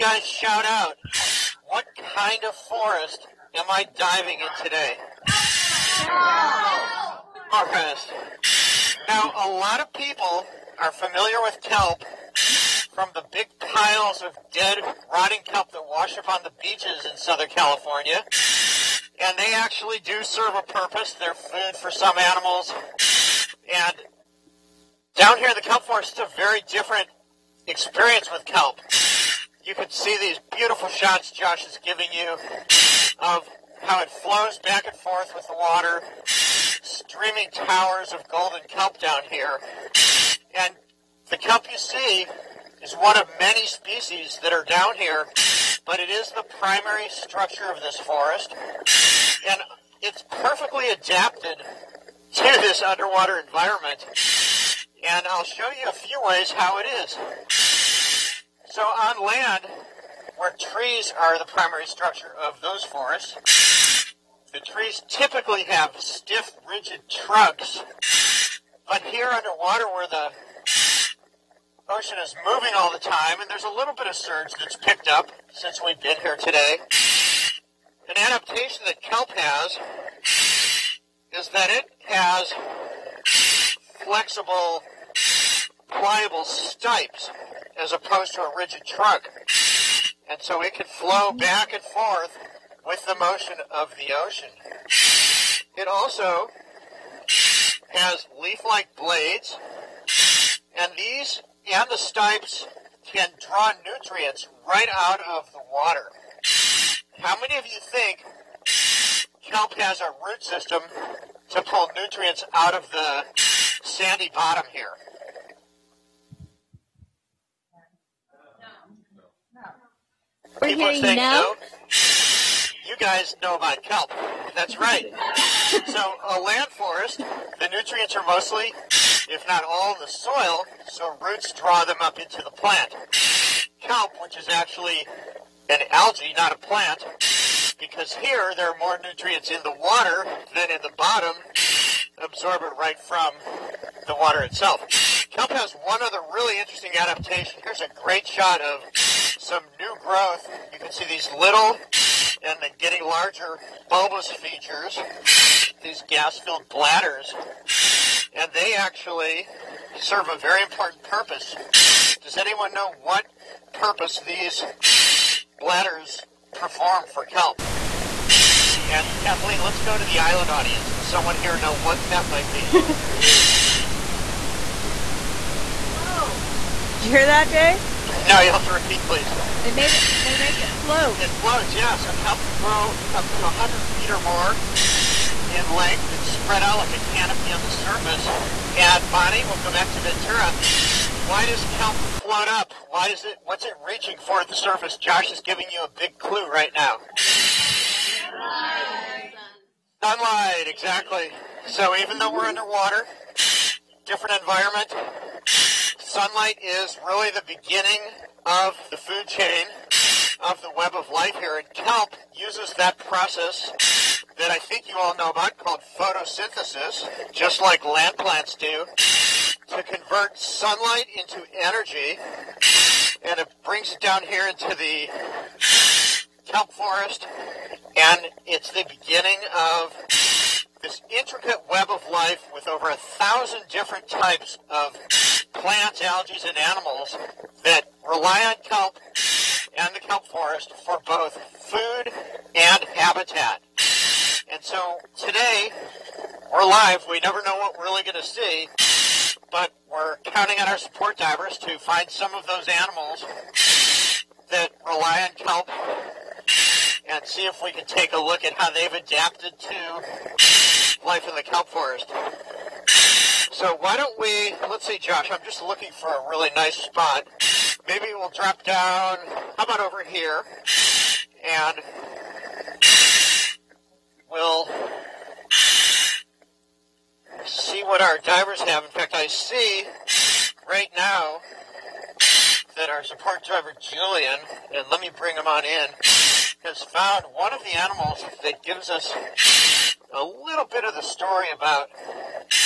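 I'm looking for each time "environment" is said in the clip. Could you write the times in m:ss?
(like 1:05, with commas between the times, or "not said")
0:53, 3:24.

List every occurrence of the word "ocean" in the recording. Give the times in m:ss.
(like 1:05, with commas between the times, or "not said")
1:11, 1:34.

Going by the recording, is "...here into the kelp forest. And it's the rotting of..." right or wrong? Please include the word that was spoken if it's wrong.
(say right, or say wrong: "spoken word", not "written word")
wrong: "beginning", not "rotting".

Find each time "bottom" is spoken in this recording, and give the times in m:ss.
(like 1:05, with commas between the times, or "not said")
1:54, 2:20.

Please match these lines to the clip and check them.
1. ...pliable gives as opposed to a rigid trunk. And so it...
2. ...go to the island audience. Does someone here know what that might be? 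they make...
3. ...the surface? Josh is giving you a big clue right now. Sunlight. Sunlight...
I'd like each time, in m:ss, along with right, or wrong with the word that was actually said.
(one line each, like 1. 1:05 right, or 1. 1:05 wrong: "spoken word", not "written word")
1. 1:25 wrong: "stipes", not "gives"
2. 2:49 right
3. 3:14 right.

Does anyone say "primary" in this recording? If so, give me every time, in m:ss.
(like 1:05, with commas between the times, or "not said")
0:46, 1:01.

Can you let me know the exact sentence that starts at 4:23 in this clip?
So why don't we, let's see, Josh, I'm just looking for a really nice spot.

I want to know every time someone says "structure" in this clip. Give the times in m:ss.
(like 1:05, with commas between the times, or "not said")
0:47, 1:01.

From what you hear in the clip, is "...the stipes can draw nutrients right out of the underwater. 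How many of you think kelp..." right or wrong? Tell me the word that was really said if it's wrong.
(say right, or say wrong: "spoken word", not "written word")
wrong: "water", not "underwater".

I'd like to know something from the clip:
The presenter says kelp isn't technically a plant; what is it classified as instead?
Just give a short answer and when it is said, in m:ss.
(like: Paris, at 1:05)
an algae, at 2:15.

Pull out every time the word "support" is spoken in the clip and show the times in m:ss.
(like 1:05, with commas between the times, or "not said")
4:10, 4:43.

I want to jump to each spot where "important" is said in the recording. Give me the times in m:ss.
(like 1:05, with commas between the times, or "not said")
2:40.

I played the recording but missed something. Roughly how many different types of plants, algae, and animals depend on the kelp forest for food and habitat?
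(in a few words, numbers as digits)
over 1000.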